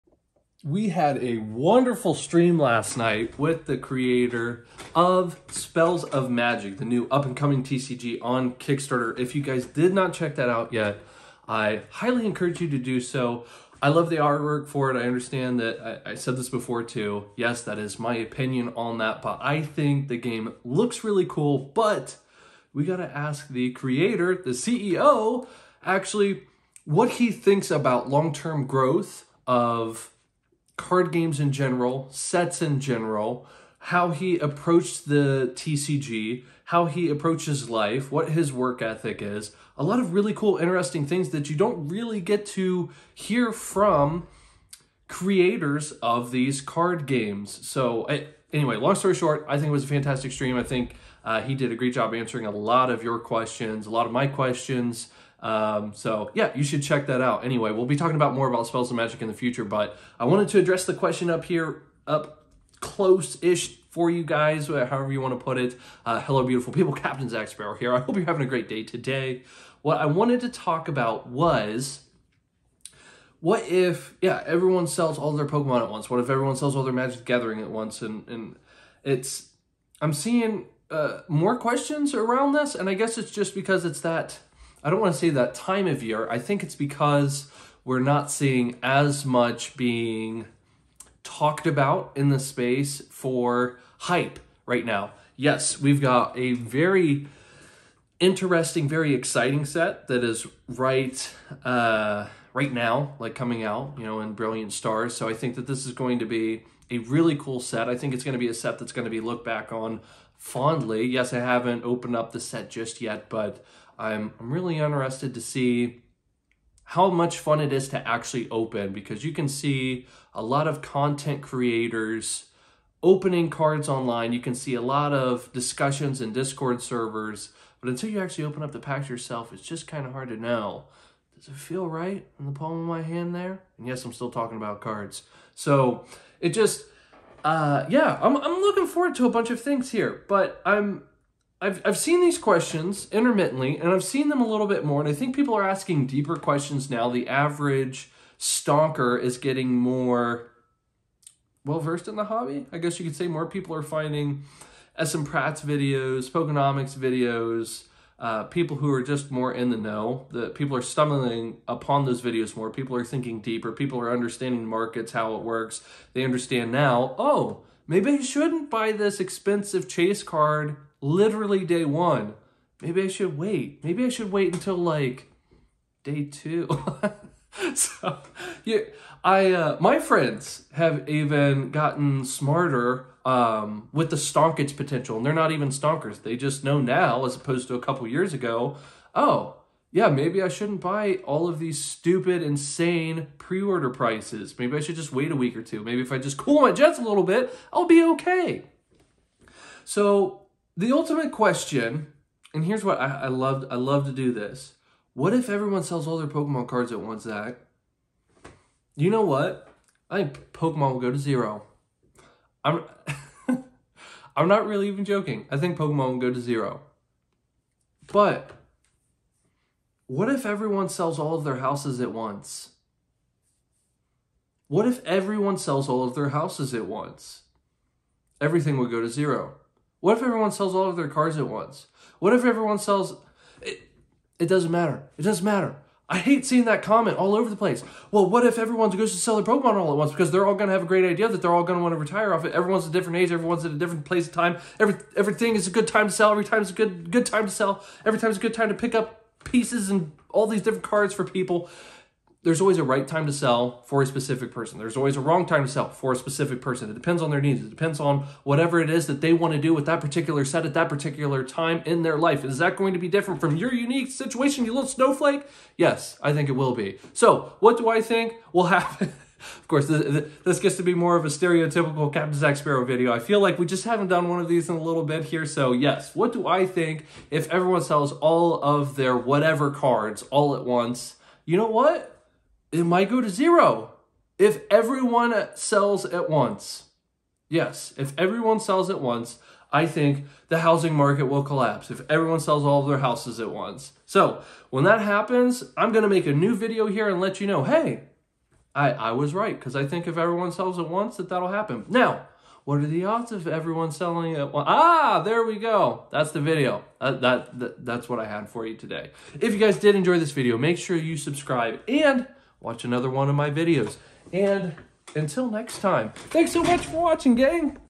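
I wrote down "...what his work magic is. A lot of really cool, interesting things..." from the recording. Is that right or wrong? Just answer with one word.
wrong.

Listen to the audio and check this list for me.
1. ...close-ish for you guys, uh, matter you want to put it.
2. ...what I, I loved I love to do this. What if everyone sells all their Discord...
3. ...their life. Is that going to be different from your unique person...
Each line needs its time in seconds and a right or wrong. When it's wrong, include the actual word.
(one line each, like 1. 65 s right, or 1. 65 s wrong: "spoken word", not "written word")
1. 62 s wrong: "however", not "matter"
2. 202 s wrong: "Pokemon", not "Discord"
3. 262 s wrong: "situation", not "person".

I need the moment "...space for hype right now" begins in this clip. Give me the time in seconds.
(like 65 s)
92 s.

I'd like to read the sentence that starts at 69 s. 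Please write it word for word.
What I wanted to talk about was what if, yeah, everyone sells all their Pokemon at once?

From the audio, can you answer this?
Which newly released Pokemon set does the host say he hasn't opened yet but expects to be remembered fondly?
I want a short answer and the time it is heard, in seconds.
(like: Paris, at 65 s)
Brilliant Stars, at 104 s.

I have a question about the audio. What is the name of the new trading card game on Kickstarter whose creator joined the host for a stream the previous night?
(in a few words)
Spells of Magic.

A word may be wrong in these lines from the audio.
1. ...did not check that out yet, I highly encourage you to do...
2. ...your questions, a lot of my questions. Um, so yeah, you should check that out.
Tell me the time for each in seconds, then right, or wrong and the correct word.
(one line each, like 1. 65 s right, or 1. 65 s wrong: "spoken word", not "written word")
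1. 9 s right
2. 53 s right.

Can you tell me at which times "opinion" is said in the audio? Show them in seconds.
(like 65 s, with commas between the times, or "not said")
18 s.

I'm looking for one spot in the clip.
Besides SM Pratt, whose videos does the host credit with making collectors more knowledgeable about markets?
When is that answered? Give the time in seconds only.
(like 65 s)
156 s.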